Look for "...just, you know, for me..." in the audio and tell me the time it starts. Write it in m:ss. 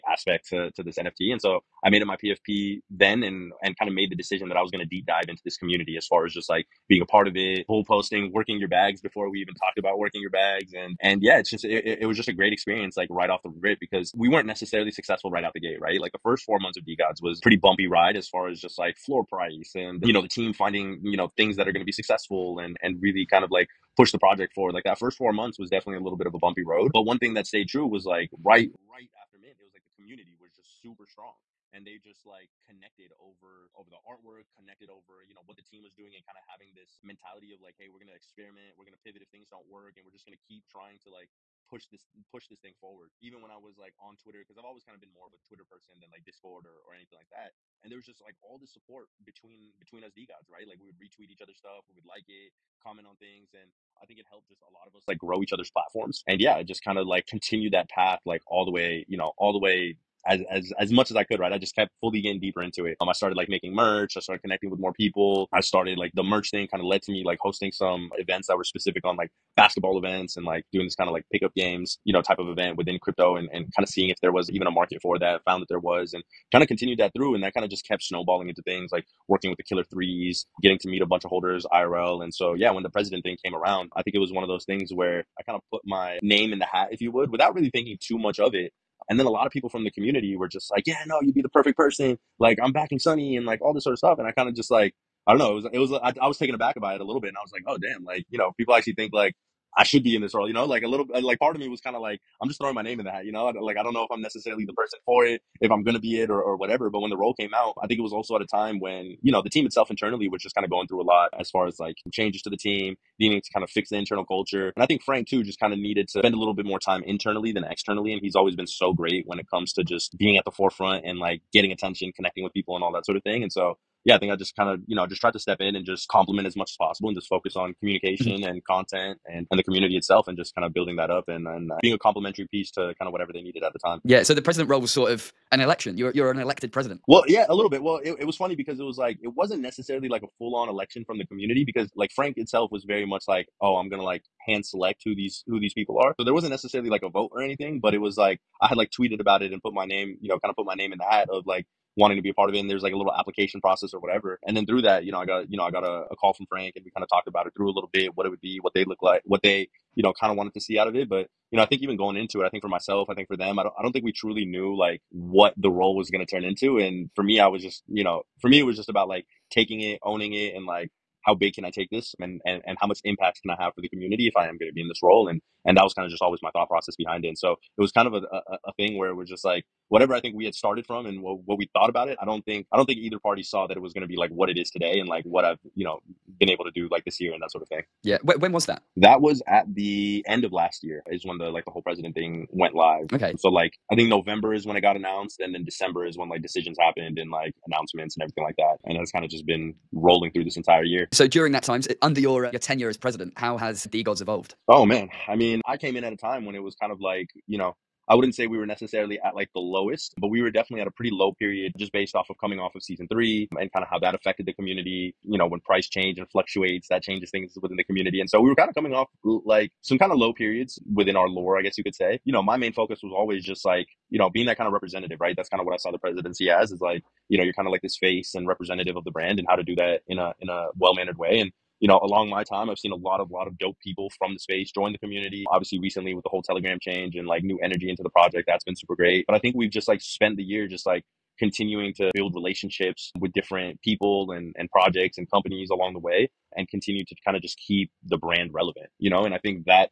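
2:47.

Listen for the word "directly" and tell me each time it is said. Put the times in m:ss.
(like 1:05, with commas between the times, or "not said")
not said.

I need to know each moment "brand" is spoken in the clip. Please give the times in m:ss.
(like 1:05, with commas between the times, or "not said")
3:49, 4:08.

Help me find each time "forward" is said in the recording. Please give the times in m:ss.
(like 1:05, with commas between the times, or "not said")
0:24, 0:42.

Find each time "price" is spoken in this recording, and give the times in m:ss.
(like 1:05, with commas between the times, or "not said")
0:19, 3:35.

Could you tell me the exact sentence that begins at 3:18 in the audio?
And it's kind of just been rolling through this entire year.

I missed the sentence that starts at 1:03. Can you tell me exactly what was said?
Um, I started like making merch.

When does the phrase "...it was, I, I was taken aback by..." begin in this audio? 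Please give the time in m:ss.
1:35.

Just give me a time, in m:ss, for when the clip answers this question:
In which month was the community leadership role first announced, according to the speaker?
3:14.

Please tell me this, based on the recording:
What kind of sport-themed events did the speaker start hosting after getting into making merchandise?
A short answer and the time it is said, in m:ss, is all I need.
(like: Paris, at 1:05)
Basketball, at 1:09.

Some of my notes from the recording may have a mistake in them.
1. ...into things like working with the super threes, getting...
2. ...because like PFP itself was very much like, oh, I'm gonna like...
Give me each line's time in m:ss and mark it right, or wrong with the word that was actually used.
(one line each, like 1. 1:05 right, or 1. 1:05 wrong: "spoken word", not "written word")
1. 1:18 wrong: "killer", not "super"
2. 2:21 wrong: "Frank", not "PFP".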